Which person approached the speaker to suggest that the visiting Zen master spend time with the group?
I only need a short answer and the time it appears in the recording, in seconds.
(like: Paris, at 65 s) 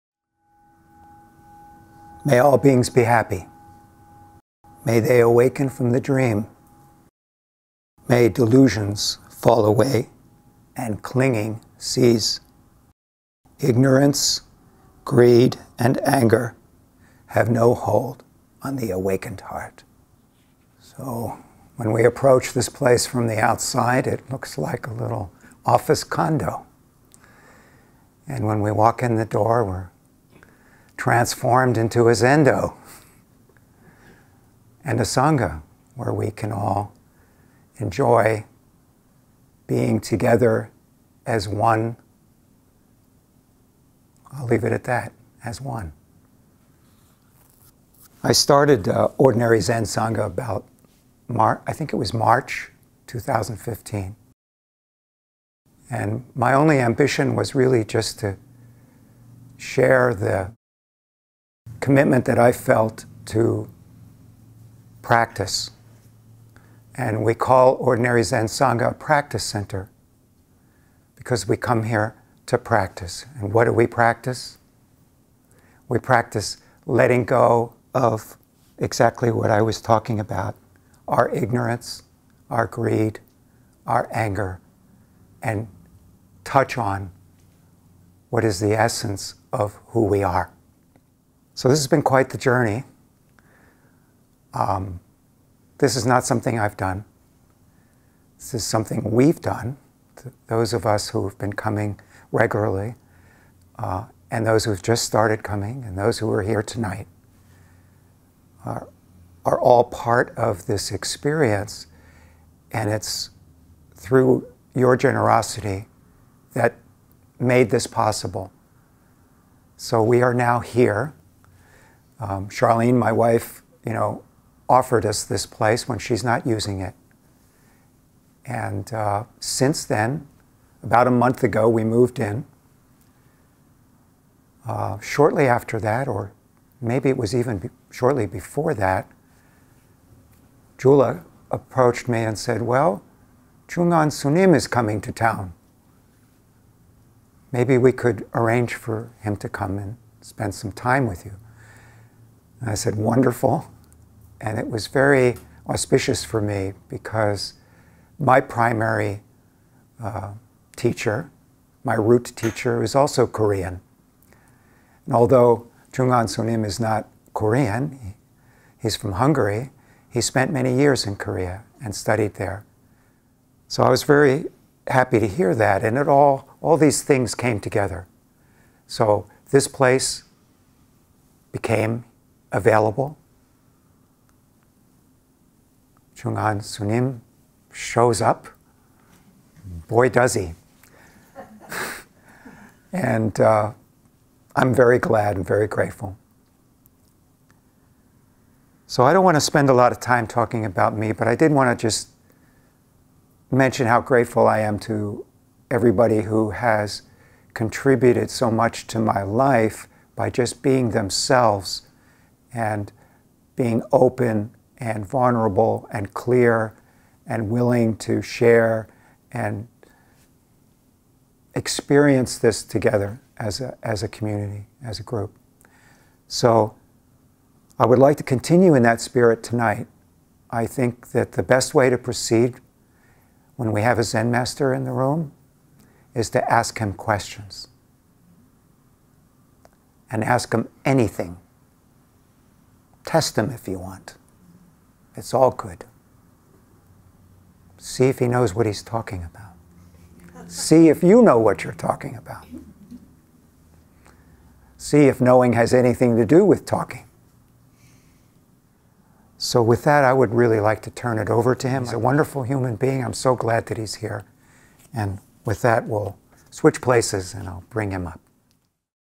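Jula, at 140 s.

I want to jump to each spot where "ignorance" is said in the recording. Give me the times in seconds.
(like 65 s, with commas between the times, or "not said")
13 s, 81 s.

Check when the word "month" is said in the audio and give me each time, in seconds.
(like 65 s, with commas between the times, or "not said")
131 s.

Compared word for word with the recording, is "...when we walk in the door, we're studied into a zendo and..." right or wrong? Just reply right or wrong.
wrong.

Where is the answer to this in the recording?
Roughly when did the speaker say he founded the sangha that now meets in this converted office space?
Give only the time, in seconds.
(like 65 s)
52 s.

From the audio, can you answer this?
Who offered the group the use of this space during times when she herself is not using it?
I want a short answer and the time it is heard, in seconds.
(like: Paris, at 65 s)
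Charlene, at 122 s.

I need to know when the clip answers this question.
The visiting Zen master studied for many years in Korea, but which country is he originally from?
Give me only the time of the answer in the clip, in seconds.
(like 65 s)
169 s.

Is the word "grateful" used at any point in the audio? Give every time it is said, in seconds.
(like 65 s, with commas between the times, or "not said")
195 s, 204 s.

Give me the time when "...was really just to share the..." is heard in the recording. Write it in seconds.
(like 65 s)
57 s.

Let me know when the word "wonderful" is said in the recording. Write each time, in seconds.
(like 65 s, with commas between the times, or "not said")
152 s, 261 s.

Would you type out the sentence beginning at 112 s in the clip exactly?
And it's through your generosity that made this possible.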